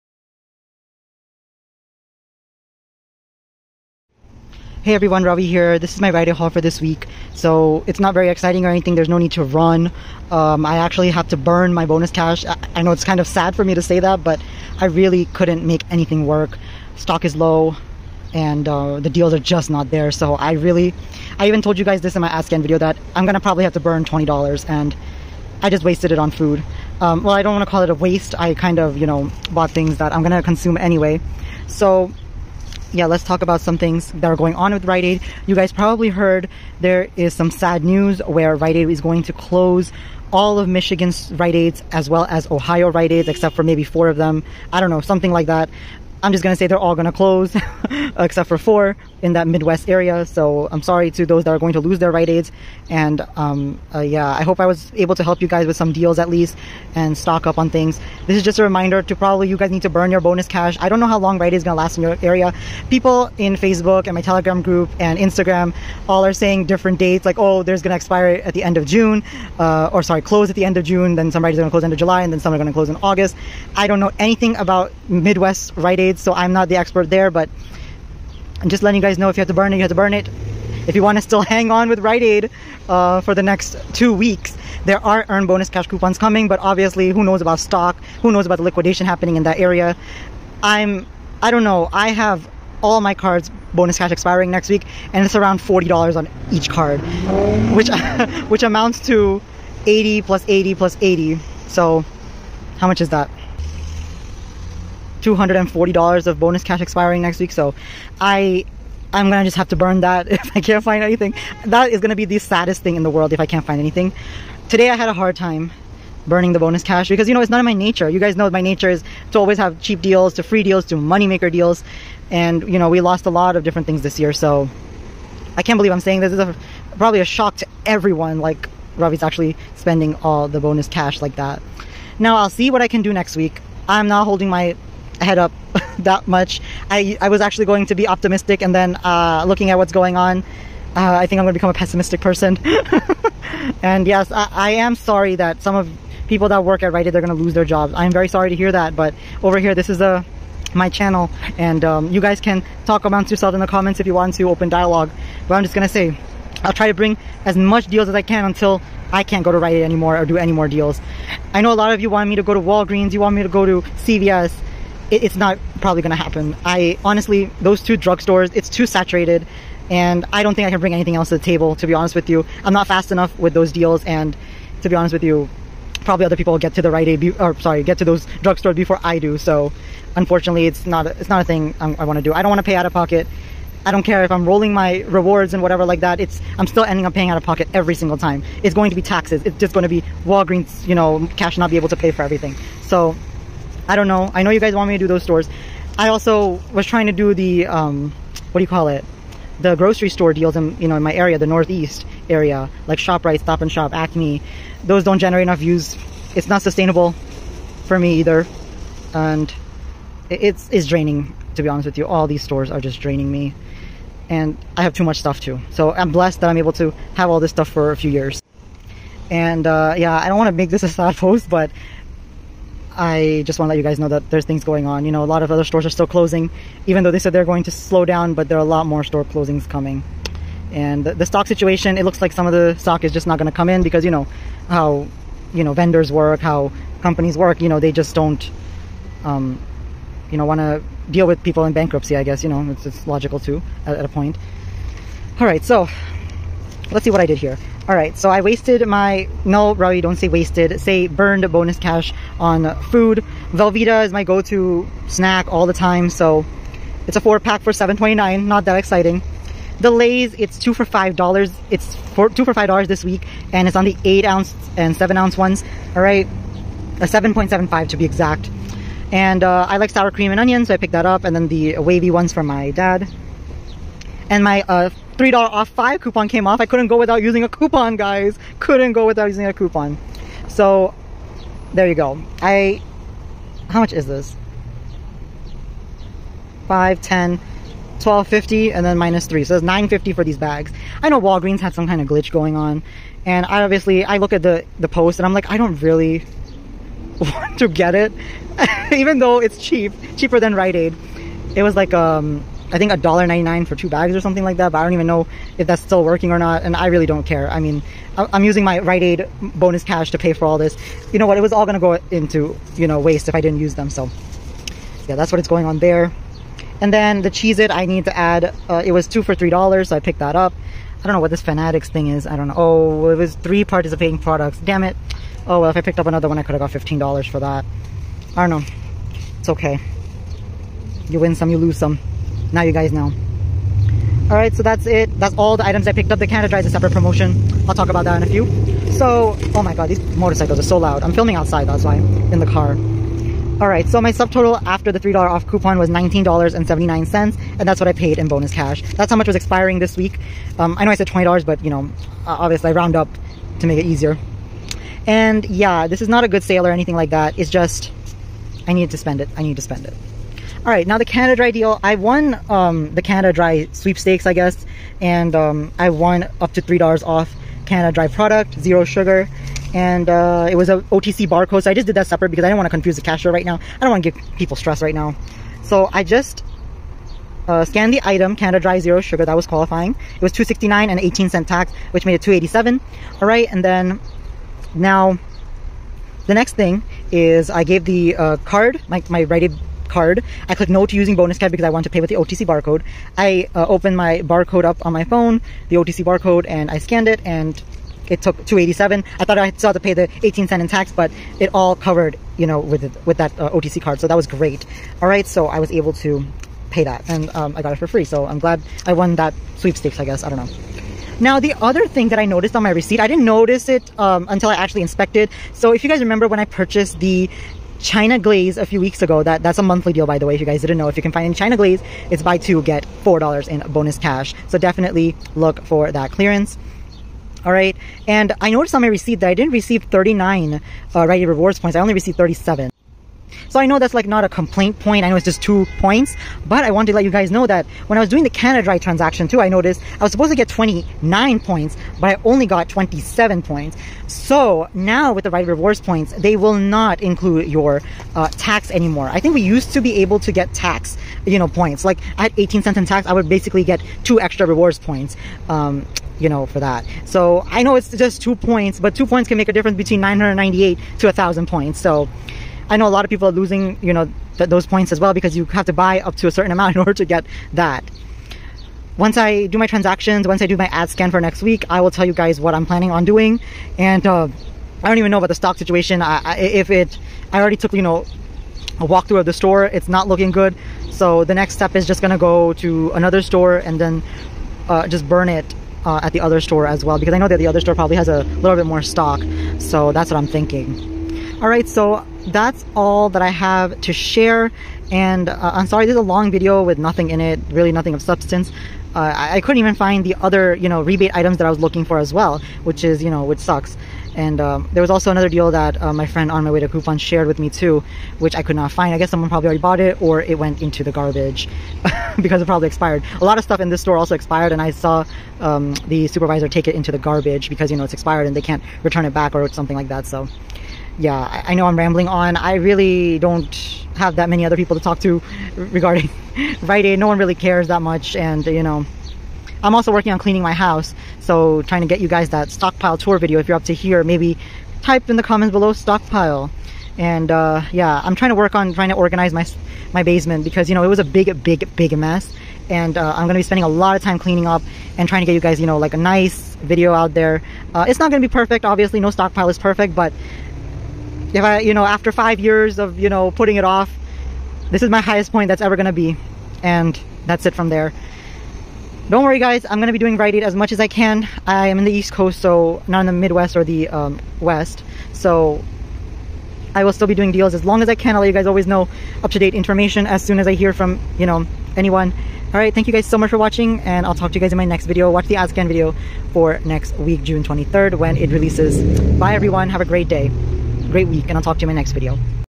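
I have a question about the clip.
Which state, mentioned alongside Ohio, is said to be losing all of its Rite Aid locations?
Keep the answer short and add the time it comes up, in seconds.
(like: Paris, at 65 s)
Michigan, at 40 s.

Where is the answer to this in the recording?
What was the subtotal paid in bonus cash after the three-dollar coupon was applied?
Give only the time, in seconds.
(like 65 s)
345 s.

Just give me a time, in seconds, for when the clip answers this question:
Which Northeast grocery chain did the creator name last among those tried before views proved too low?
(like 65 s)
203 s.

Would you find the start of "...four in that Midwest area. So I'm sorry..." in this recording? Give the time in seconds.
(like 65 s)
48 s.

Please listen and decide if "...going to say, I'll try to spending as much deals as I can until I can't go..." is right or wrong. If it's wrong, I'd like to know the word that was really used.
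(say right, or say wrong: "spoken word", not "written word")
wrong: "bring", not "spending".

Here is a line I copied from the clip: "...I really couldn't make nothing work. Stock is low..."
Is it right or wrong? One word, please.
wrong.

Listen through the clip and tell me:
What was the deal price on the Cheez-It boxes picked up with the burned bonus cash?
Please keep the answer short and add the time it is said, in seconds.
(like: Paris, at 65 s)
two for $3, at 319 s.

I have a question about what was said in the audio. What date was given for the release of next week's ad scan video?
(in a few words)
June 23rd.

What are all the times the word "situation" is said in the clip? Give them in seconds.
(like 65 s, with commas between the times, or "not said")
231 s, 475 s.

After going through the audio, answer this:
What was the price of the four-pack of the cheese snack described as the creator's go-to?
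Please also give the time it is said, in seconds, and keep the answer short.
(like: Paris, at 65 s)
$7.29, at 257 s.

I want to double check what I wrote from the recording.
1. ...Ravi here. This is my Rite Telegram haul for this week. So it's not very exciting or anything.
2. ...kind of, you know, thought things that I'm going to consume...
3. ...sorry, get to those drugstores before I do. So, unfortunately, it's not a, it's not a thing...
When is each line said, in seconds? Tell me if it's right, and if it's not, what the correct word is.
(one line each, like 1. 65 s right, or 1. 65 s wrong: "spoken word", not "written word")
1. 5 s wrong: "Aid", not "Telegram"
2. 28 s wrong: "bought", not "thought"
3. 177 s right.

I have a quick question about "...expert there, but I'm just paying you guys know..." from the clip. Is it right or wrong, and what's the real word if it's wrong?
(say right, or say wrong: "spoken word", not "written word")
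wrong: "letting", not "paying".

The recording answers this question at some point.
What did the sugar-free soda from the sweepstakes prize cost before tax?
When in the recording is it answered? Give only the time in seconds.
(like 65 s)
380 s.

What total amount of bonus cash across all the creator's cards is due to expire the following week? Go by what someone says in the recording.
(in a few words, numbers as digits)
$240.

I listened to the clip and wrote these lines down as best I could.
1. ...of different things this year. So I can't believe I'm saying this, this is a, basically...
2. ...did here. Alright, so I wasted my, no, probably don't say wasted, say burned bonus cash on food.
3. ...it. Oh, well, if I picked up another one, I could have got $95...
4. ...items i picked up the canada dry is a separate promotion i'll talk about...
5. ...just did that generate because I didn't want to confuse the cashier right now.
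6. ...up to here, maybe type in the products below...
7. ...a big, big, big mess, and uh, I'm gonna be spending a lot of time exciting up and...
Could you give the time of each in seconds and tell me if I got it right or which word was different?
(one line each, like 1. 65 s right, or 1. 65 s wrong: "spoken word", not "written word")
1. 123 s wrong: "probably", not "basically"
2. 247 s right
3. 324 s wrong: "15", not "95"
4. 335 s right
5. 371 s wrong: "separate", not "generate"
6. 533 s wrong: "comments", not "products"
7. 540 s wrong: "cleaning", not "exciting".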